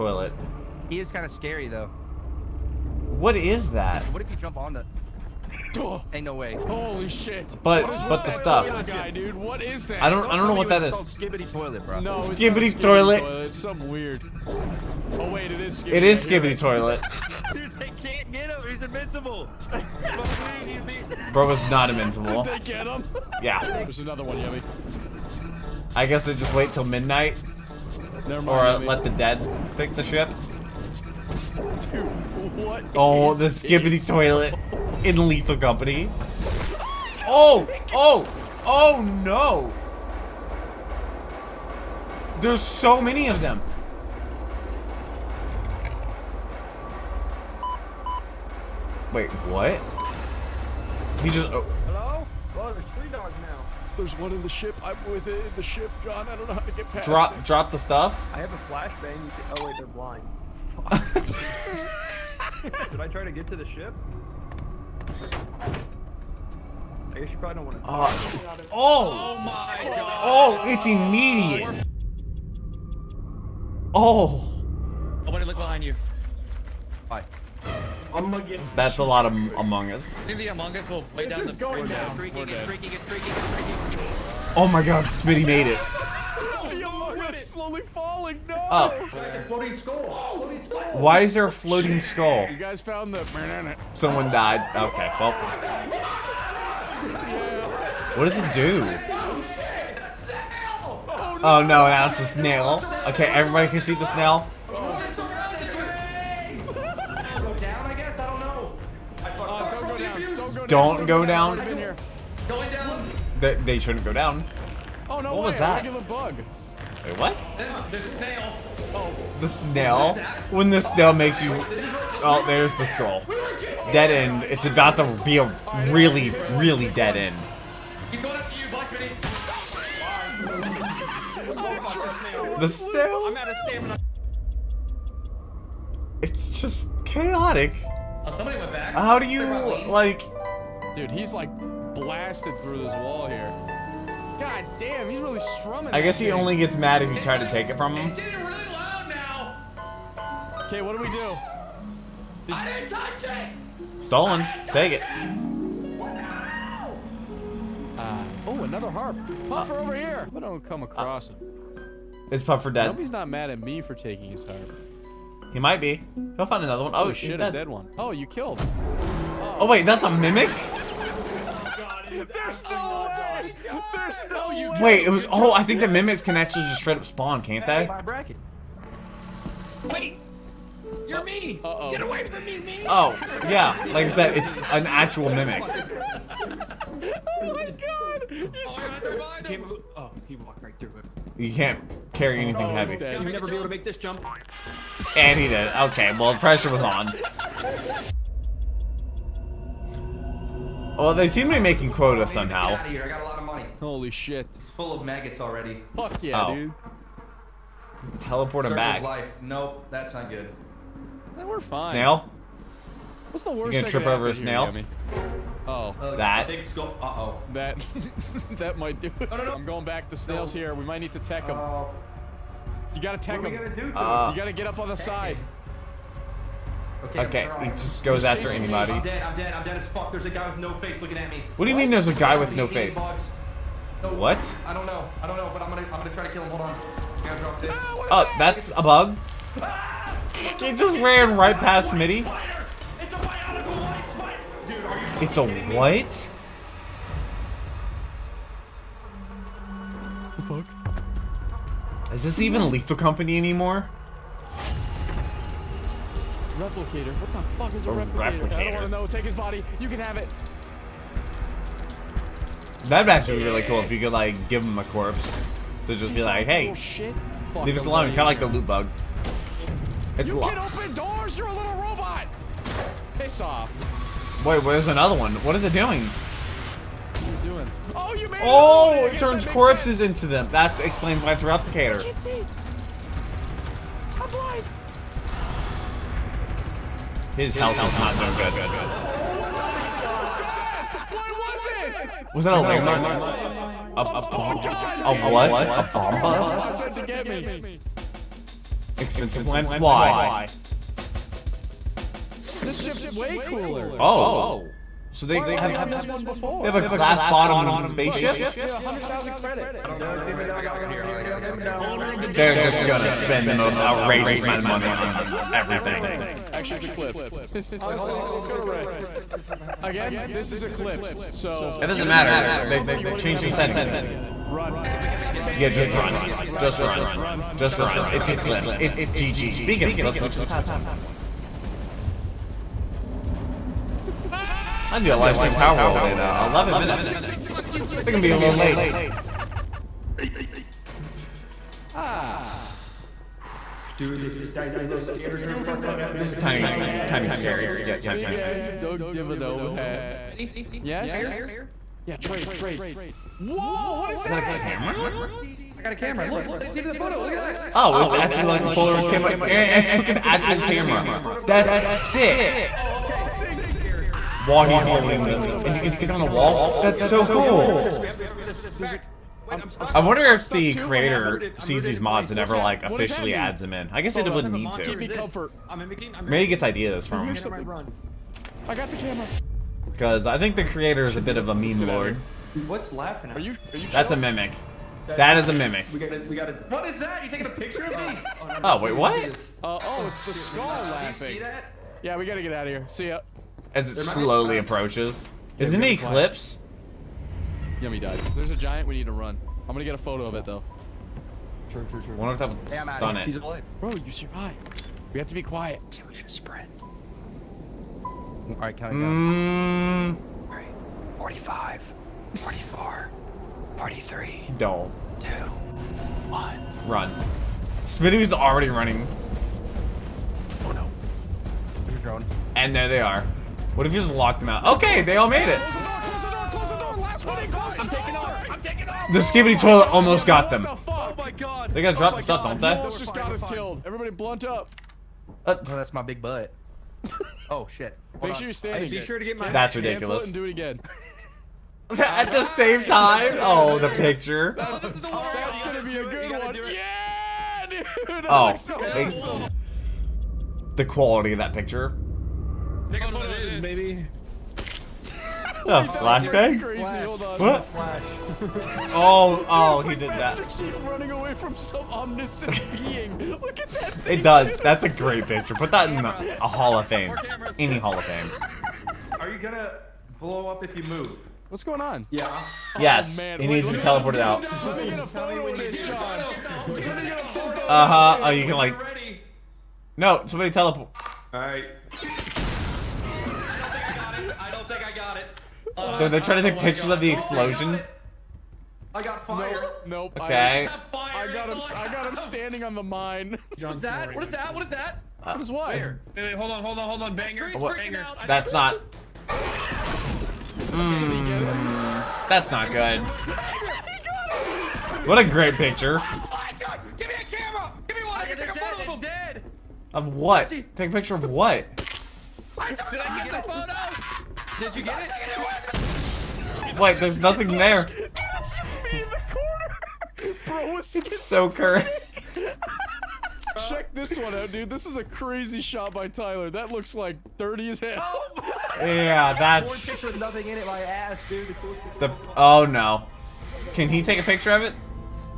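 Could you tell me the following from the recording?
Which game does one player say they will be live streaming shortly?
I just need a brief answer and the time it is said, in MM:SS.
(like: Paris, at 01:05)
Palworld, at 05:35.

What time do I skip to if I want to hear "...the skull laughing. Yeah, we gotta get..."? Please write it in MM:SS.
06:30.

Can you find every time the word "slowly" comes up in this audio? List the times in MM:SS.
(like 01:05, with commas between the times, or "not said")
01:27, 06:34.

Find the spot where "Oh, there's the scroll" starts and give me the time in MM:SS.
02:02.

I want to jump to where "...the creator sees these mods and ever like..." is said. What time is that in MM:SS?
06:10.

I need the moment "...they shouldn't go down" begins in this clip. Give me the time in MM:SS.
01:53.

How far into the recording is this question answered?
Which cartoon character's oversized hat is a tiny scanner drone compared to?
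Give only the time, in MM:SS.
05:48.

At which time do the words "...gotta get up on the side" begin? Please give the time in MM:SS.
03:44.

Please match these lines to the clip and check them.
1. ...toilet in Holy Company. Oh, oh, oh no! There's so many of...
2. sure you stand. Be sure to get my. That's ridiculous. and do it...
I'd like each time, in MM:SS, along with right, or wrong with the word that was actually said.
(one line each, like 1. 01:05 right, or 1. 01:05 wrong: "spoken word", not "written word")
1. 00:34 wrong: "Lethal", not "Holy"
2. 07:18 right.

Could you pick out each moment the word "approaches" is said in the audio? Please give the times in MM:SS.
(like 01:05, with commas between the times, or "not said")
06:34.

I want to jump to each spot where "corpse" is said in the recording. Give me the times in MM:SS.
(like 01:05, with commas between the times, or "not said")
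04:24, 04:39.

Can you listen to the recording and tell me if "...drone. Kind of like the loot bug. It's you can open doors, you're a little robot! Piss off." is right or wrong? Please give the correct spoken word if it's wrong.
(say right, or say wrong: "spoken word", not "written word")
wrong: "alone", not "drone".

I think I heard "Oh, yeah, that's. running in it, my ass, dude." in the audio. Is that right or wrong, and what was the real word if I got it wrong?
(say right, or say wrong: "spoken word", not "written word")
wrong: "nothing", not "running".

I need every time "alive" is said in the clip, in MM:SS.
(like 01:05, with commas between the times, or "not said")
06:43.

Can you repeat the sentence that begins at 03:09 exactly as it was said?
oh, he walked right through it.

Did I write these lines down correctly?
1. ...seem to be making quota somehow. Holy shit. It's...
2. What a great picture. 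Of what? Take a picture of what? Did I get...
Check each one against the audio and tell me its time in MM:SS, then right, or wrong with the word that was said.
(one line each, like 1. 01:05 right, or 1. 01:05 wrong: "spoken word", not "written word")
1. 03:21 right
2. 08:25 right.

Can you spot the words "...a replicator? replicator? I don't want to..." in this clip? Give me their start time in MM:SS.
04:17.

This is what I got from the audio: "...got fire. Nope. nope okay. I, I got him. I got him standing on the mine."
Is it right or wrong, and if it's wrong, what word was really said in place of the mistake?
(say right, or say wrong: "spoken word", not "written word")
right.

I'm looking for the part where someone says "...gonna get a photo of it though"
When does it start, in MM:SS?
06:39.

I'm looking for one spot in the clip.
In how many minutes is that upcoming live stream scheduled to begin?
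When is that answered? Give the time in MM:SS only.
05:36.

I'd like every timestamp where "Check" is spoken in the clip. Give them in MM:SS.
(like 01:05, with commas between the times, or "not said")
08:43.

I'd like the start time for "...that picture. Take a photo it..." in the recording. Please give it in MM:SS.
07:31.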